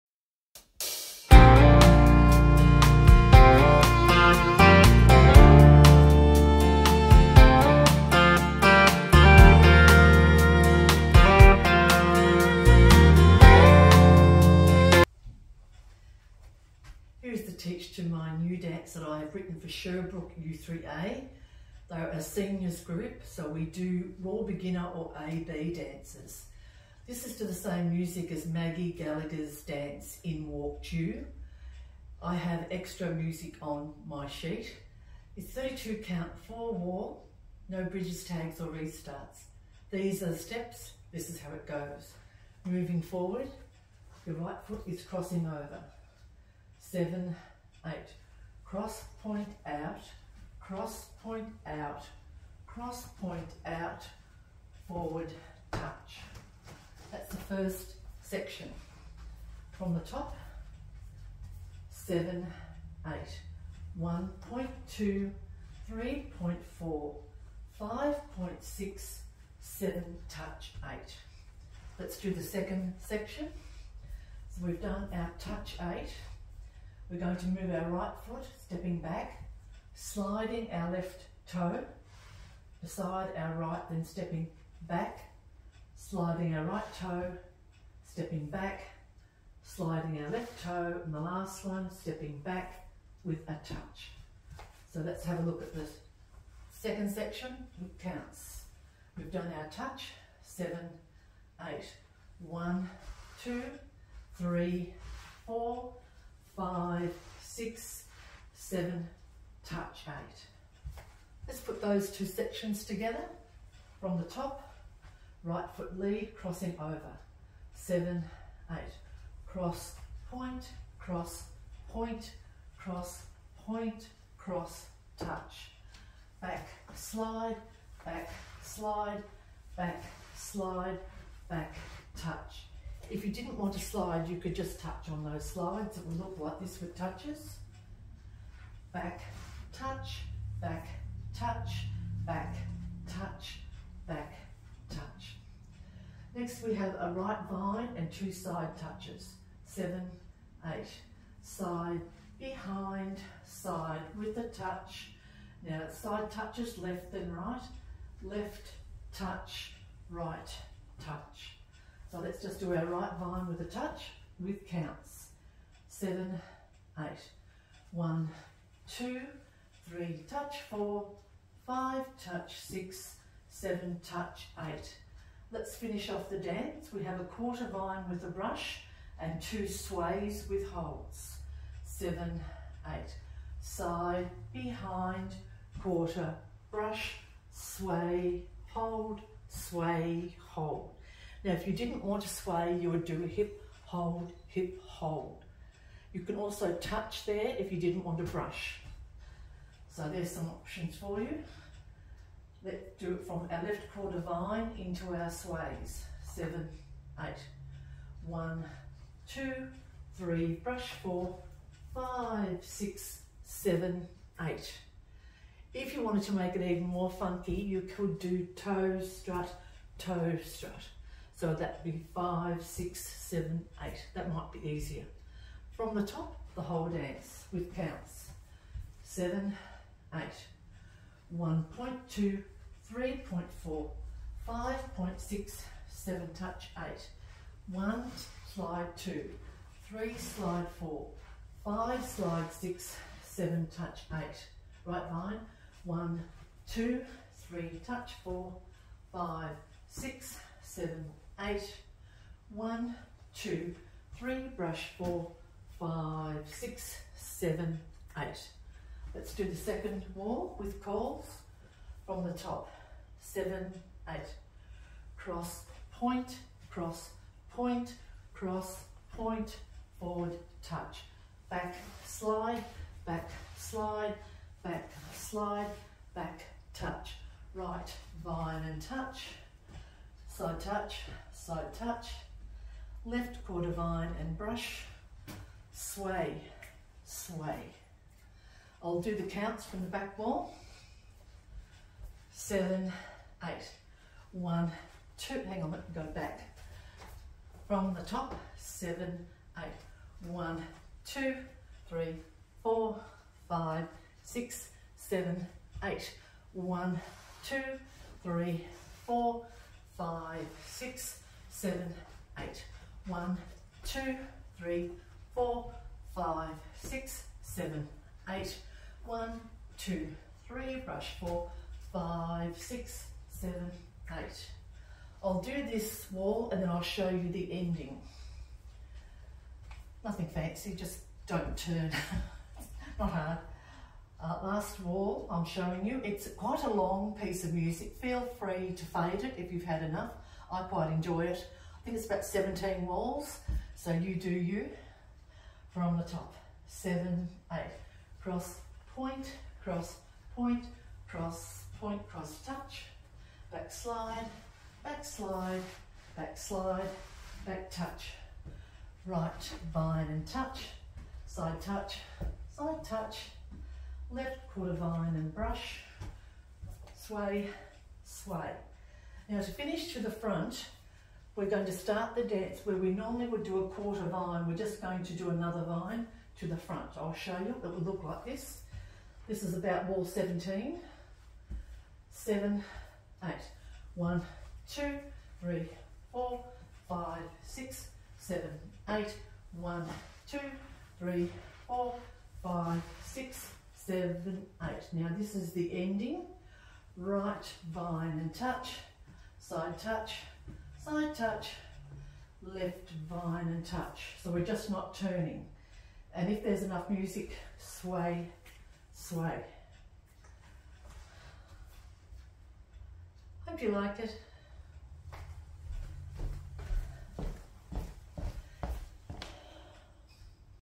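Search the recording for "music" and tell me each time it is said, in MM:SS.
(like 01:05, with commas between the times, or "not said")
00:27, 00:33, 05:37, 06:46.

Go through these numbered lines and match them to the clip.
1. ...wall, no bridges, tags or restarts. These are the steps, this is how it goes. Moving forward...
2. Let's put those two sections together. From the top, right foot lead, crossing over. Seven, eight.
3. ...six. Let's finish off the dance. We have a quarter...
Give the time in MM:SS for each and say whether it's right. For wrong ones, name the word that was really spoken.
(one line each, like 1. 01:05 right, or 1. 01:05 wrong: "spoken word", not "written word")
1. 00:36 right
2. 01:51 right
3. 02:54 wrong: "eight", not "six".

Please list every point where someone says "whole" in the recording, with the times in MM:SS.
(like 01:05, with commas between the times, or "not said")
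03:46.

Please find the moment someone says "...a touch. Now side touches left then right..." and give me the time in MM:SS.
02:34.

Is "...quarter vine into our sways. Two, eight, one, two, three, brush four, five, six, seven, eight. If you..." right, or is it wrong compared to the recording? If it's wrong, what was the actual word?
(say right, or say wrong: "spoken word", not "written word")
wrong: "Seven", not "Two".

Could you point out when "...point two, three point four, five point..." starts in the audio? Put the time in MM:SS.
01:04.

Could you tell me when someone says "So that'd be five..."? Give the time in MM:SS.
03:41.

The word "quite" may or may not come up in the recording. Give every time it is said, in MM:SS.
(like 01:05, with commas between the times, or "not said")
05:36, 05:40.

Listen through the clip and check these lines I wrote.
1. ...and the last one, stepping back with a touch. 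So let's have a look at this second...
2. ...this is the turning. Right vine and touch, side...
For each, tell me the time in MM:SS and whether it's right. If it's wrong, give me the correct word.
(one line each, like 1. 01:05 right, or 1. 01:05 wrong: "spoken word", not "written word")
1. 01:31 right
2. 06:35 wrong: "ending", not "turning".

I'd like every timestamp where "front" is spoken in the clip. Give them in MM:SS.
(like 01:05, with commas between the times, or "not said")
06:10, 06:16.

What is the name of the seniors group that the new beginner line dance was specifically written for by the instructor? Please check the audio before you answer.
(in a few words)
Sherbrooke U3A.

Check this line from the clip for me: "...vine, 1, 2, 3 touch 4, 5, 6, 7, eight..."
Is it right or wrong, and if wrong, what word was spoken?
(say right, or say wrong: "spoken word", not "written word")
right.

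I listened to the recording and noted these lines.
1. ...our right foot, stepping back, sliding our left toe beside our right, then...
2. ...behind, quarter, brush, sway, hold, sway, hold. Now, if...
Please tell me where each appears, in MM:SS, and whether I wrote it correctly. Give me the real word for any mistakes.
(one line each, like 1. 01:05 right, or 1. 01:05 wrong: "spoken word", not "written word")
1. 01:17 right
2. 03:04 right.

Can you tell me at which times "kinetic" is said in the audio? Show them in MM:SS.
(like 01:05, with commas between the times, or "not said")
not said.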